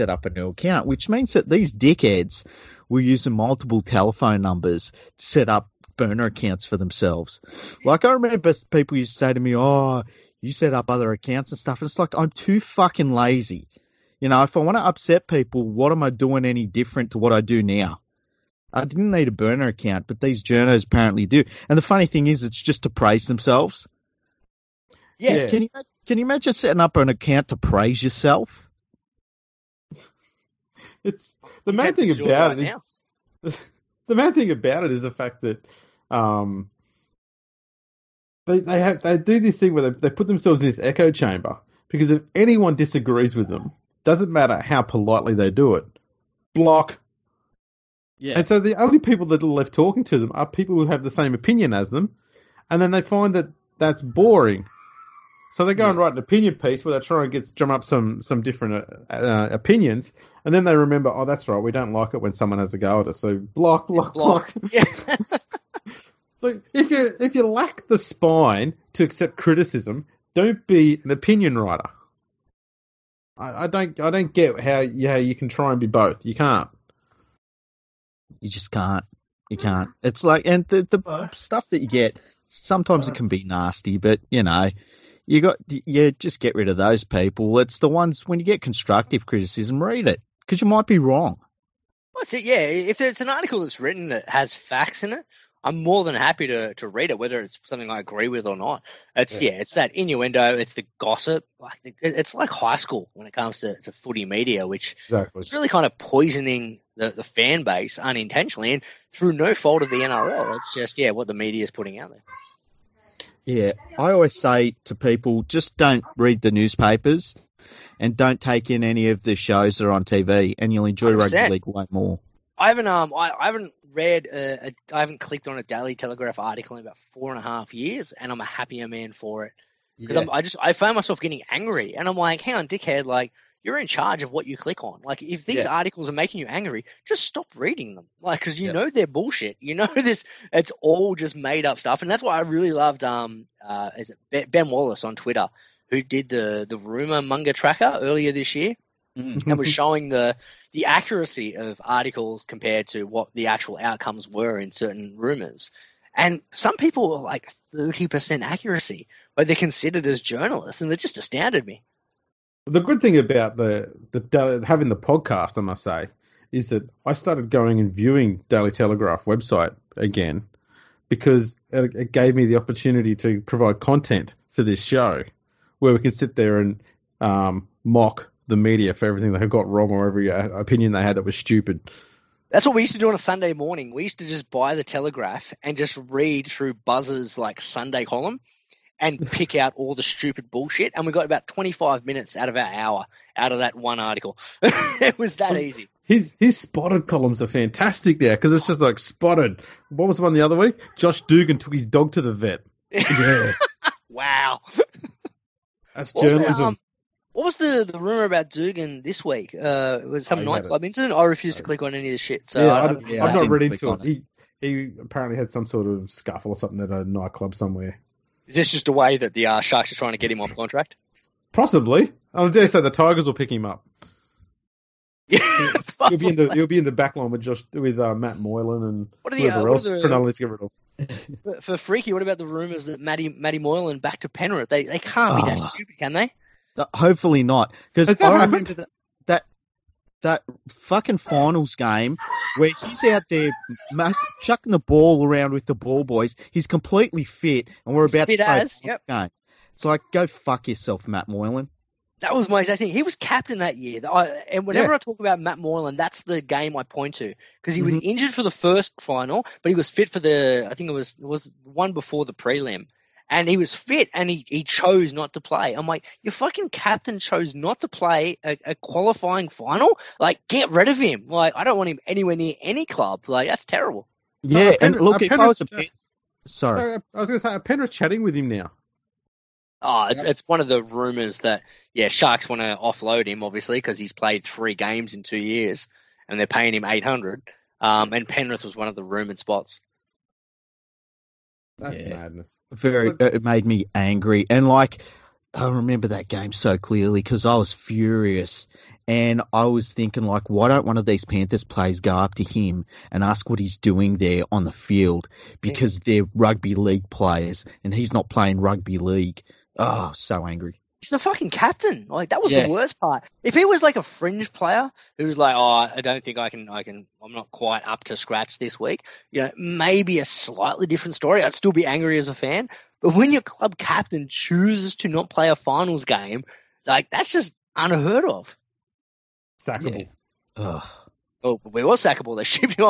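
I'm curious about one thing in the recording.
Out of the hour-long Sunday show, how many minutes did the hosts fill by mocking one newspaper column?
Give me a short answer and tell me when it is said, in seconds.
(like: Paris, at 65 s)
25, at 191 s.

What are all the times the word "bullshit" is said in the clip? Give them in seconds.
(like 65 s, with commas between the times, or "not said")
139 s, 190 s.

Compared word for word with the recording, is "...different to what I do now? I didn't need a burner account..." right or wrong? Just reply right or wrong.
right.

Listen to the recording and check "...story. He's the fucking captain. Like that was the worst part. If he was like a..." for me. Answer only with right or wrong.
wrong.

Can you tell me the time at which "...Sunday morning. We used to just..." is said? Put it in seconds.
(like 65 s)
183 s.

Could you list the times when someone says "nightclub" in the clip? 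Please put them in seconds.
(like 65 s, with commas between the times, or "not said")
210 s, 217 s.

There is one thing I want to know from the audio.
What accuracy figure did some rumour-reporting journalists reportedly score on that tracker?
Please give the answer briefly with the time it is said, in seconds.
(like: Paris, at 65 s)
30%, at 157 s.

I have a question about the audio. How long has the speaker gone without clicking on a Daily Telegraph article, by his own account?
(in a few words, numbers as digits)
4 and a half years.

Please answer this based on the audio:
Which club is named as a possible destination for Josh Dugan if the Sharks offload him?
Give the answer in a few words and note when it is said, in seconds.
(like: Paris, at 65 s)
Tigers, at 222 s.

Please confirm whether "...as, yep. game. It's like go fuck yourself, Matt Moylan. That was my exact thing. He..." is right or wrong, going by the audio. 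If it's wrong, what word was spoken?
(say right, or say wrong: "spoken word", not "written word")
right.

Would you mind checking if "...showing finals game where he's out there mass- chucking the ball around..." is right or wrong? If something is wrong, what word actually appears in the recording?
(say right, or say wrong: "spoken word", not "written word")
wrong: "fucking", not "showing".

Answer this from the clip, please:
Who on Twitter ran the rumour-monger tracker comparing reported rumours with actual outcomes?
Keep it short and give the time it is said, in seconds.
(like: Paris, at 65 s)
Ben Wallace, at 144 s.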